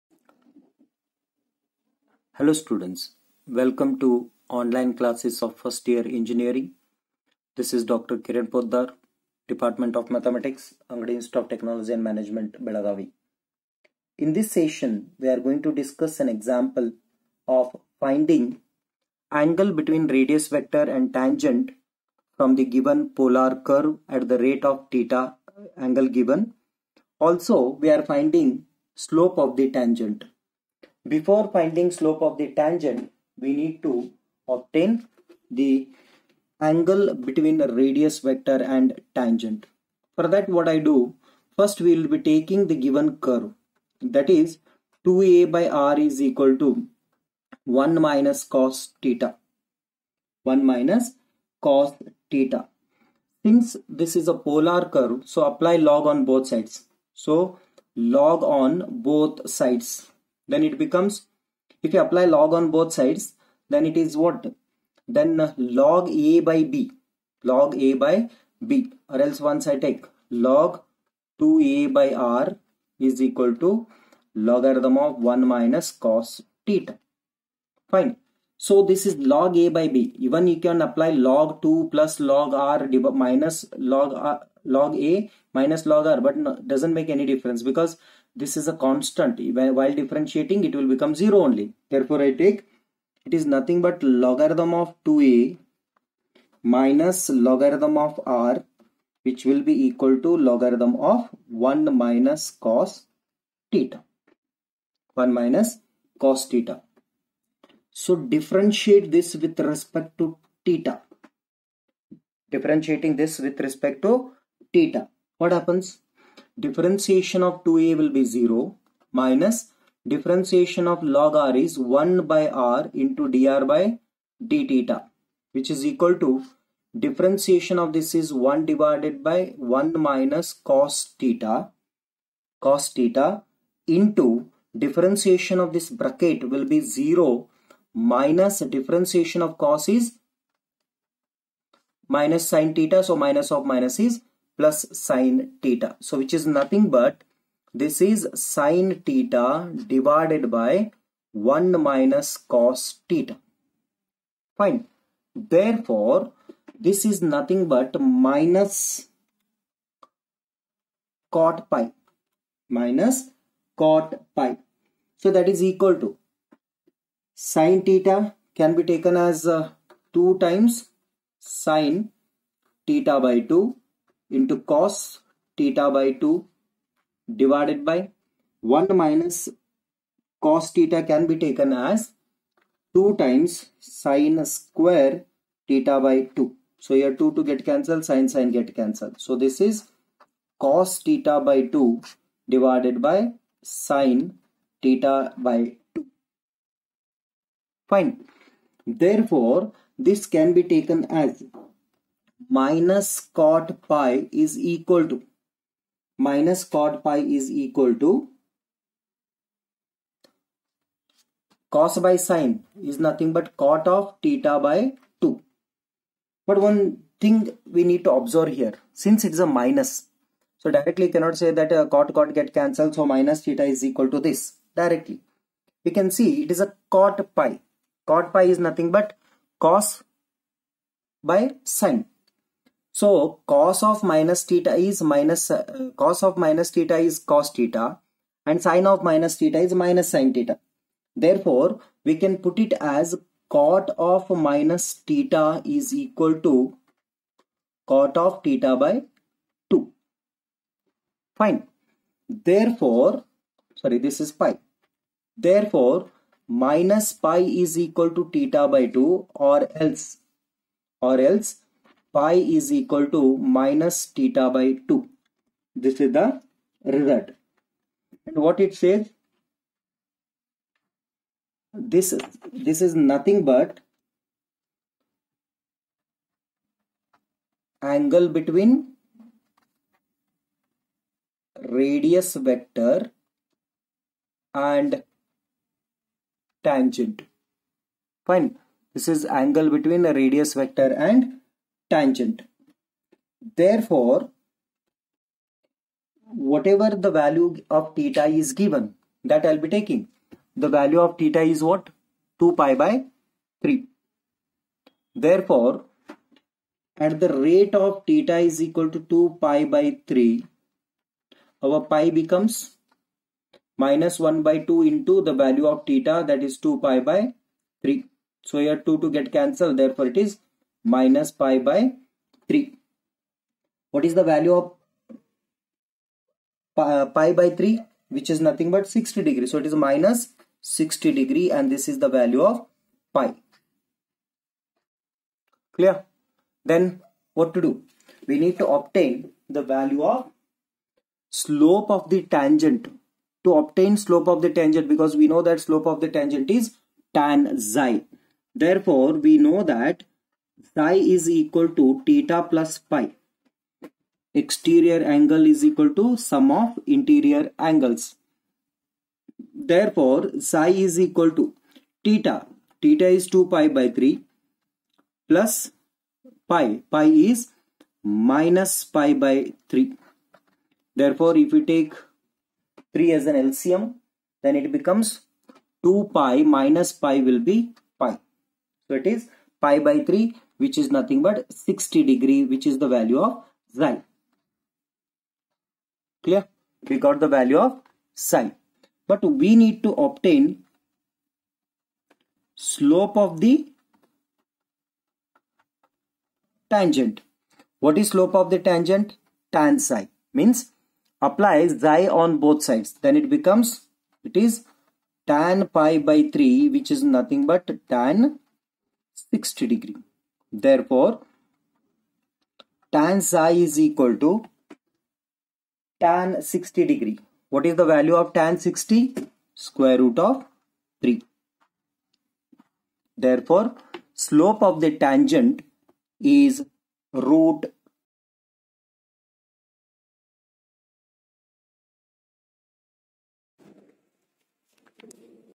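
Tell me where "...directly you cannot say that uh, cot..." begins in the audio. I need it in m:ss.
3:40.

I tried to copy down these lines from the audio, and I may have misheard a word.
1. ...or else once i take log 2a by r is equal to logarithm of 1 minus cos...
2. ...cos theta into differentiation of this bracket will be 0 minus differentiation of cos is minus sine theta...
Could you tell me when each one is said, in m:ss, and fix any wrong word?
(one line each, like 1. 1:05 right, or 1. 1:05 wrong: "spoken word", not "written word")
1. 1:09 right
2. 2:12 right.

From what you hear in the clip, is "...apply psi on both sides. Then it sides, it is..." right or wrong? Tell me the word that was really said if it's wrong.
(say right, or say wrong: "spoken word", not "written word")
wrong: "becomes", not "sides".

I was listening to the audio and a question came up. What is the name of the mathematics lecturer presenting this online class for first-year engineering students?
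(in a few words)
Dr. Kiran Potadar.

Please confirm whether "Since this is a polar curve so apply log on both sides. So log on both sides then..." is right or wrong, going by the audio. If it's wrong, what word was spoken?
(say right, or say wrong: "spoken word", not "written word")
right.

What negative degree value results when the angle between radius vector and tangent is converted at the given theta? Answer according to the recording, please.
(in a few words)
-60 degrees.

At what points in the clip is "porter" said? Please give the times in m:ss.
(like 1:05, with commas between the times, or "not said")
not said.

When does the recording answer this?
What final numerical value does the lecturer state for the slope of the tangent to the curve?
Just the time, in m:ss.
6:59.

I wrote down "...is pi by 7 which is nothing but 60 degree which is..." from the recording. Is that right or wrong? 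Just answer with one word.
wrong.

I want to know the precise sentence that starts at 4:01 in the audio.
Therefore, we can put it as cot of minus theta is equal to cot of theta by 2.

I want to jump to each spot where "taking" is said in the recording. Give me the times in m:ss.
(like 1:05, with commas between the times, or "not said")
0:42, 4:59.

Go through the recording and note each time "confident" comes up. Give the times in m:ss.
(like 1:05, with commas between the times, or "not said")
not said.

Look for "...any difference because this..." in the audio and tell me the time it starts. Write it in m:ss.
1:27.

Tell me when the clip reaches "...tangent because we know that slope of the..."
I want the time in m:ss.
5:44.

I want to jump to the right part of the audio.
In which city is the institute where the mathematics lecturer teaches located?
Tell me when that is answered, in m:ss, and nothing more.
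0:12.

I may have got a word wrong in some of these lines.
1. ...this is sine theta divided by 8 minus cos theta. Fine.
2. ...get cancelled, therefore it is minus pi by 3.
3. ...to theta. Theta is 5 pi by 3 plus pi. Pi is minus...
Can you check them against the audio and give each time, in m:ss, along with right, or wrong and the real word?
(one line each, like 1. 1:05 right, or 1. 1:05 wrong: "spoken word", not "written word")
1. 2:27 wrong: "1", not "8"
2. 5:19 right
3. 6:01 wrong: "2", not "5".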